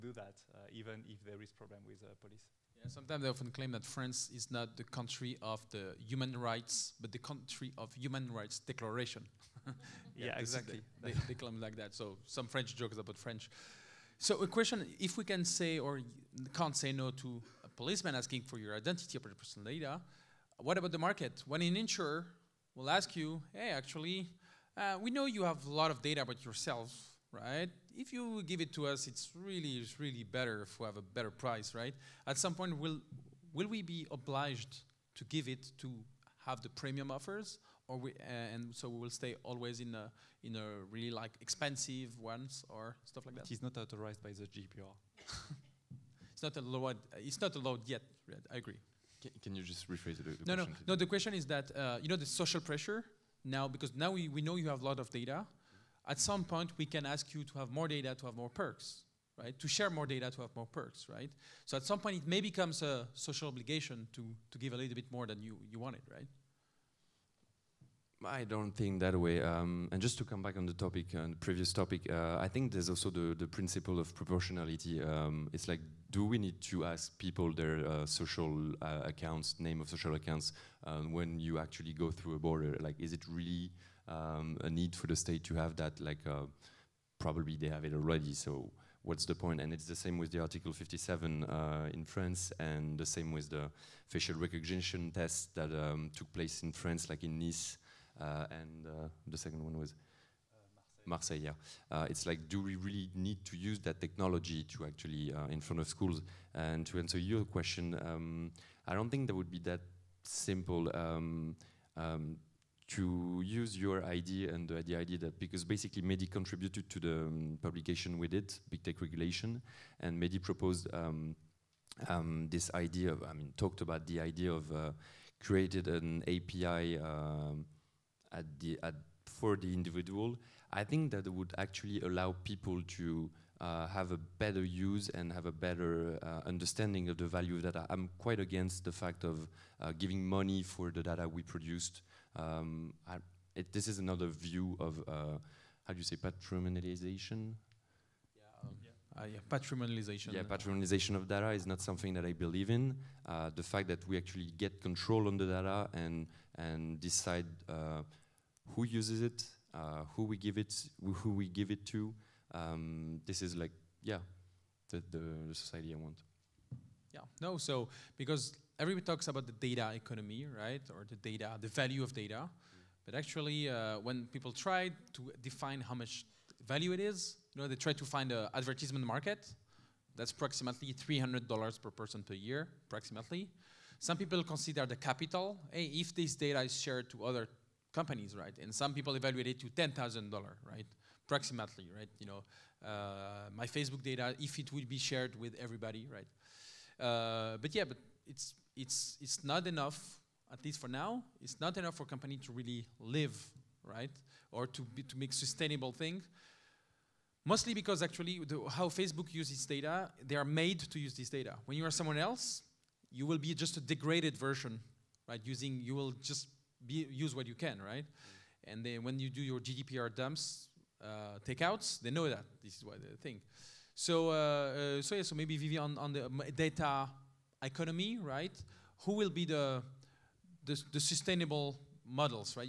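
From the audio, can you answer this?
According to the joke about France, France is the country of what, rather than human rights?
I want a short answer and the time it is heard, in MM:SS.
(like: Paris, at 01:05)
Human rights declaration, at 00:07.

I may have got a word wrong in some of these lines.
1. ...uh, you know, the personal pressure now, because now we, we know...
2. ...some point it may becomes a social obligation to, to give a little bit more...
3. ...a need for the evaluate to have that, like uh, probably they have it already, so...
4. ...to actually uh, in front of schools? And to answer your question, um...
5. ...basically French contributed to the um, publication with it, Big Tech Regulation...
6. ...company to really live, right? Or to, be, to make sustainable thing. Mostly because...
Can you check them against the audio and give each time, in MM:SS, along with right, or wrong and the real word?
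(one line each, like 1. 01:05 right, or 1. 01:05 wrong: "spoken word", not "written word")
1. 00:51 wrong: "social", not "personal"
2. 01:01 right
3. 01:24 wrong: "state", not "evaluate"
4. 01:44 right
5. 01:55 wrong: "MEDI", not "French"
6. 03:22 right.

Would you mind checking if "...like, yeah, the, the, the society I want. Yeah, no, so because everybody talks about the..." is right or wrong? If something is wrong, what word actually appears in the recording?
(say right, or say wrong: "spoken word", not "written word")
right.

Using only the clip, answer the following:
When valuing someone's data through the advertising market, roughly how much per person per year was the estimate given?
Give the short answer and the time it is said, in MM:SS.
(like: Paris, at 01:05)
$300, at 03:00.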